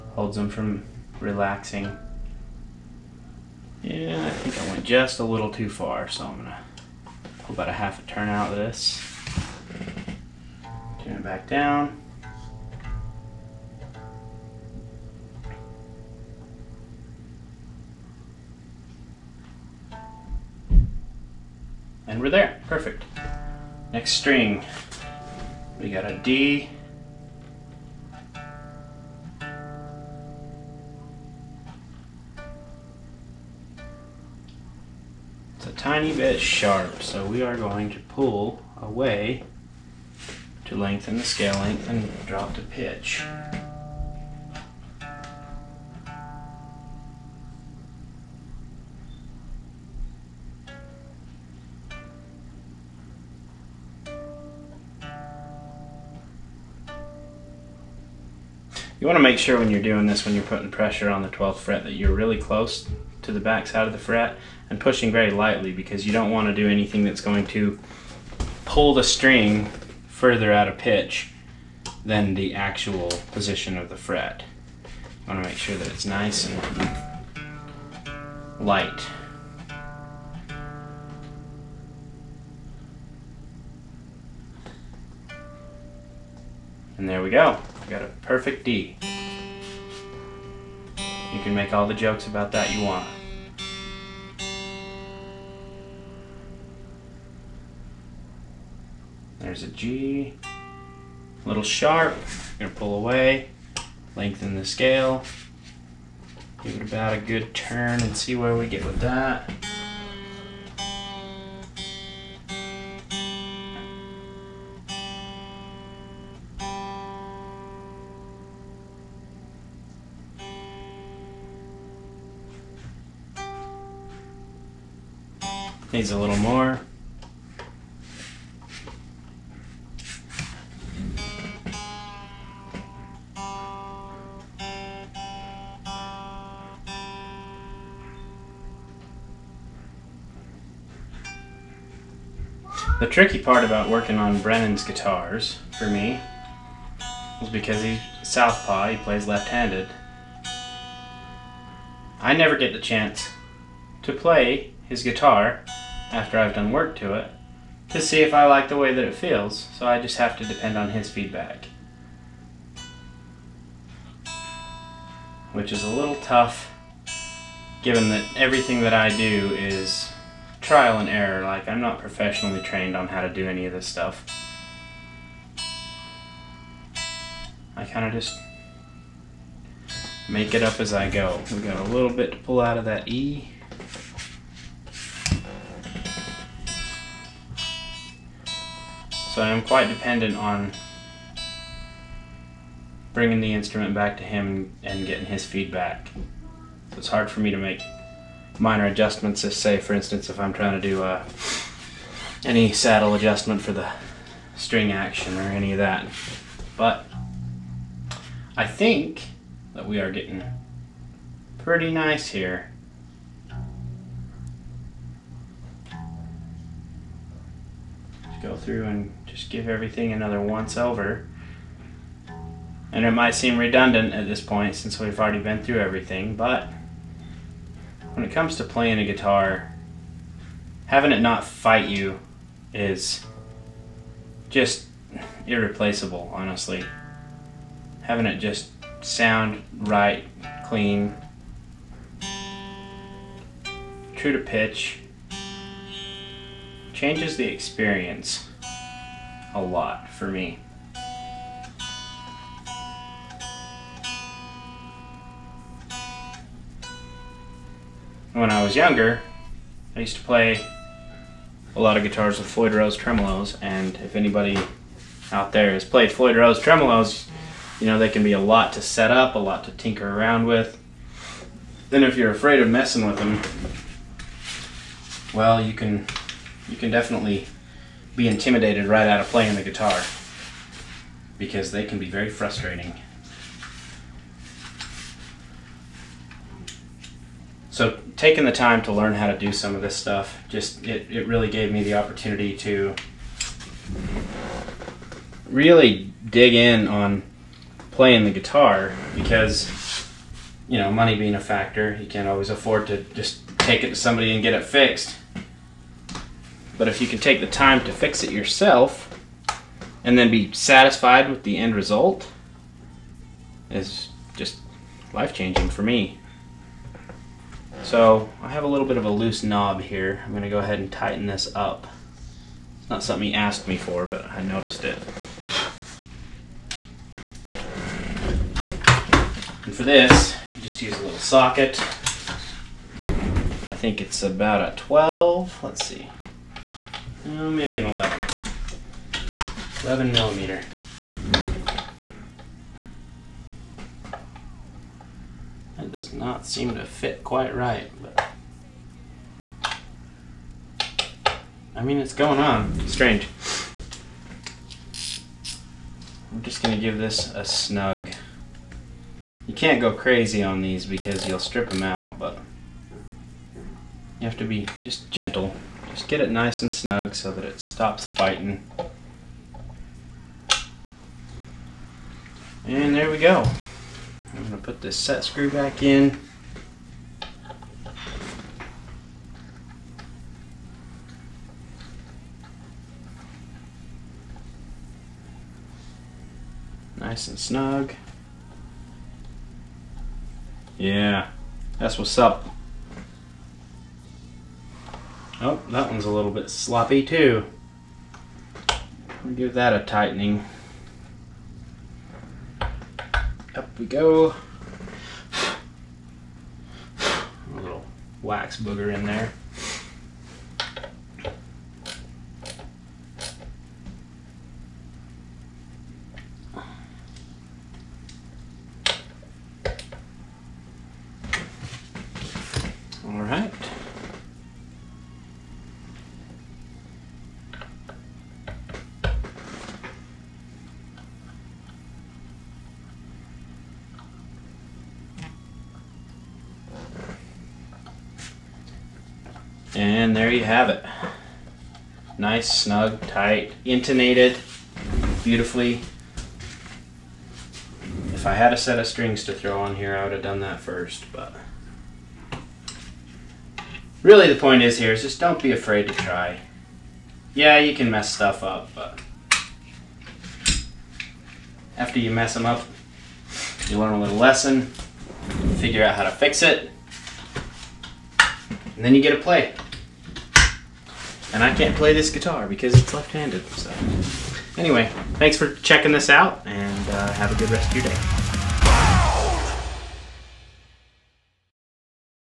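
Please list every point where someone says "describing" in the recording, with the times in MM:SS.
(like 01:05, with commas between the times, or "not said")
not said.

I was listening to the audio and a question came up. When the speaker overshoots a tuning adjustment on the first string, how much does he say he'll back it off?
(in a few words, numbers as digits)
half a turn.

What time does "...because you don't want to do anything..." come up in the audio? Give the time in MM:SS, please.
01:05.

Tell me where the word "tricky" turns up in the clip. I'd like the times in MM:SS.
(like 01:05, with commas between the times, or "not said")
02:23.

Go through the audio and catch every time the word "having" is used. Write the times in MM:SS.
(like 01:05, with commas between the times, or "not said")
03:50, 03:58.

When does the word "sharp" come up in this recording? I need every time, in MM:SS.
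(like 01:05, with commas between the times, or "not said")
00:36, 01:41.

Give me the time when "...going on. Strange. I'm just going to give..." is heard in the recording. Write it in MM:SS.
05:52.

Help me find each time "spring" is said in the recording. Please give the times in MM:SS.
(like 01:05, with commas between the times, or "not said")
not said.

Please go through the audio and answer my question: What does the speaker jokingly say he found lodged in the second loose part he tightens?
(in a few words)
wax booger.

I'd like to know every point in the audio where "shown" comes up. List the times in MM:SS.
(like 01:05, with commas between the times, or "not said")
not said.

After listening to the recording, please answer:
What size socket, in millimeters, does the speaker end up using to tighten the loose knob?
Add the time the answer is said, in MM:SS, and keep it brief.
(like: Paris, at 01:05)
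11, at 05:39.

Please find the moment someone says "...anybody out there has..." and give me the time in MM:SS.
04:24.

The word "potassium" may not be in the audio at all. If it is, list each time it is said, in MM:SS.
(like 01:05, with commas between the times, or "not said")
not said.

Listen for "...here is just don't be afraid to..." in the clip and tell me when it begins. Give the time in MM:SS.
07:34.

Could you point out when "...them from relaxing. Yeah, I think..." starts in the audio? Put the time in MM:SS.
00:00.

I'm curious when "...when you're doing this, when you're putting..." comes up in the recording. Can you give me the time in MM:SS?
00:59.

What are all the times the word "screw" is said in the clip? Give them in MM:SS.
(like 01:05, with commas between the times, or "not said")
06:15.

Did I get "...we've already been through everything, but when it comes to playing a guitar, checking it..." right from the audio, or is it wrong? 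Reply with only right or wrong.
wrong.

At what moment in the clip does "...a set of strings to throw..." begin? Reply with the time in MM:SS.
07:28.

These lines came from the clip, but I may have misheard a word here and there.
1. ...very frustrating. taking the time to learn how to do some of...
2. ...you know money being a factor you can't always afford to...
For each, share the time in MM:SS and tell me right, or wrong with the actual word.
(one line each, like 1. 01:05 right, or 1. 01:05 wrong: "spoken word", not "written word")
1. 04:42 right
2. 05:00 right.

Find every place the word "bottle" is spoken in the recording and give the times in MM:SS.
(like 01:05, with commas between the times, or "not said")
not said.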